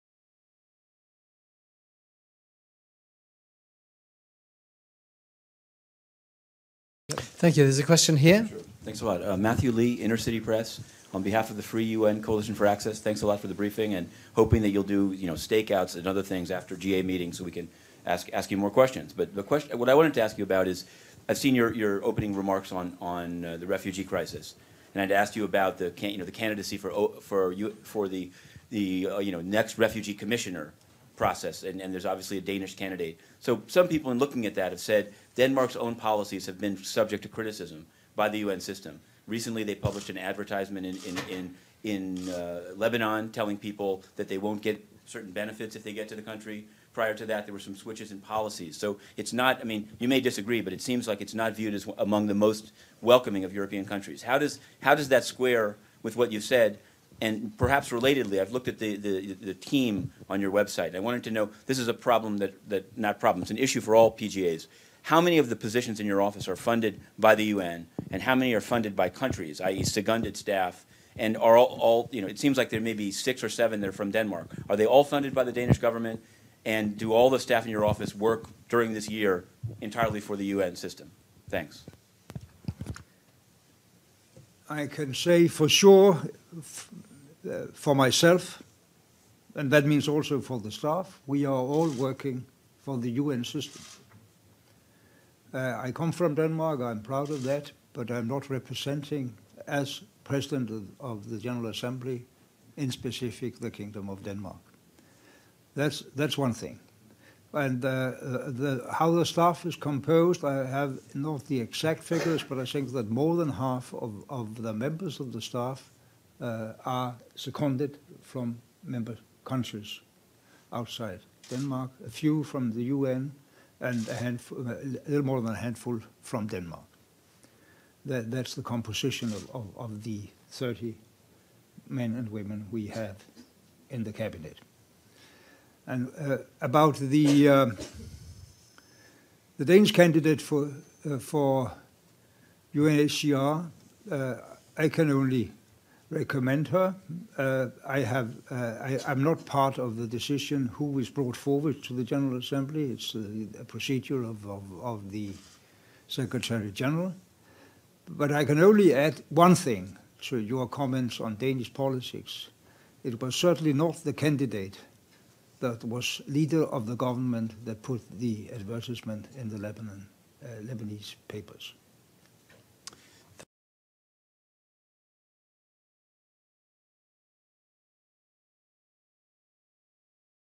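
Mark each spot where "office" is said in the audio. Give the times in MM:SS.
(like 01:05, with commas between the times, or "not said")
01:06, 01:17.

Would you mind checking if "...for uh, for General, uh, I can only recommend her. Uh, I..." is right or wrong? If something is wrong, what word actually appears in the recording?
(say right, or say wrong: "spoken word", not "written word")
wrong: "UNHCR", not "General".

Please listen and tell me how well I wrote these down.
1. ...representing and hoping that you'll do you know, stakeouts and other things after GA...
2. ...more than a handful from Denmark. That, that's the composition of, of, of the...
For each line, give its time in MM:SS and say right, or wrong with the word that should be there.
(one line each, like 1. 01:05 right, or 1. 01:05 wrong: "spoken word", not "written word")
1. 00:13 wrong: "briefing", not "representing"
2. 02:05 right.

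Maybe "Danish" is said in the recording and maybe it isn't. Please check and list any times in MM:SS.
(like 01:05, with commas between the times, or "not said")
00:32, 01:15, 02:19, 02:41.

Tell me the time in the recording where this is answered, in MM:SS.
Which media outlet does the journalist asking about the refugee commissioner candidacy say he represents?
00:09.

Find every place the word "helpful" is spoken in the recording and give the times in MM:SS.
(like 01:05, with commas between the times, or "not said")
not said.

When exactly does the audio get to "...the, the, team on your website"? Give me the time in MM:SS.
00:58.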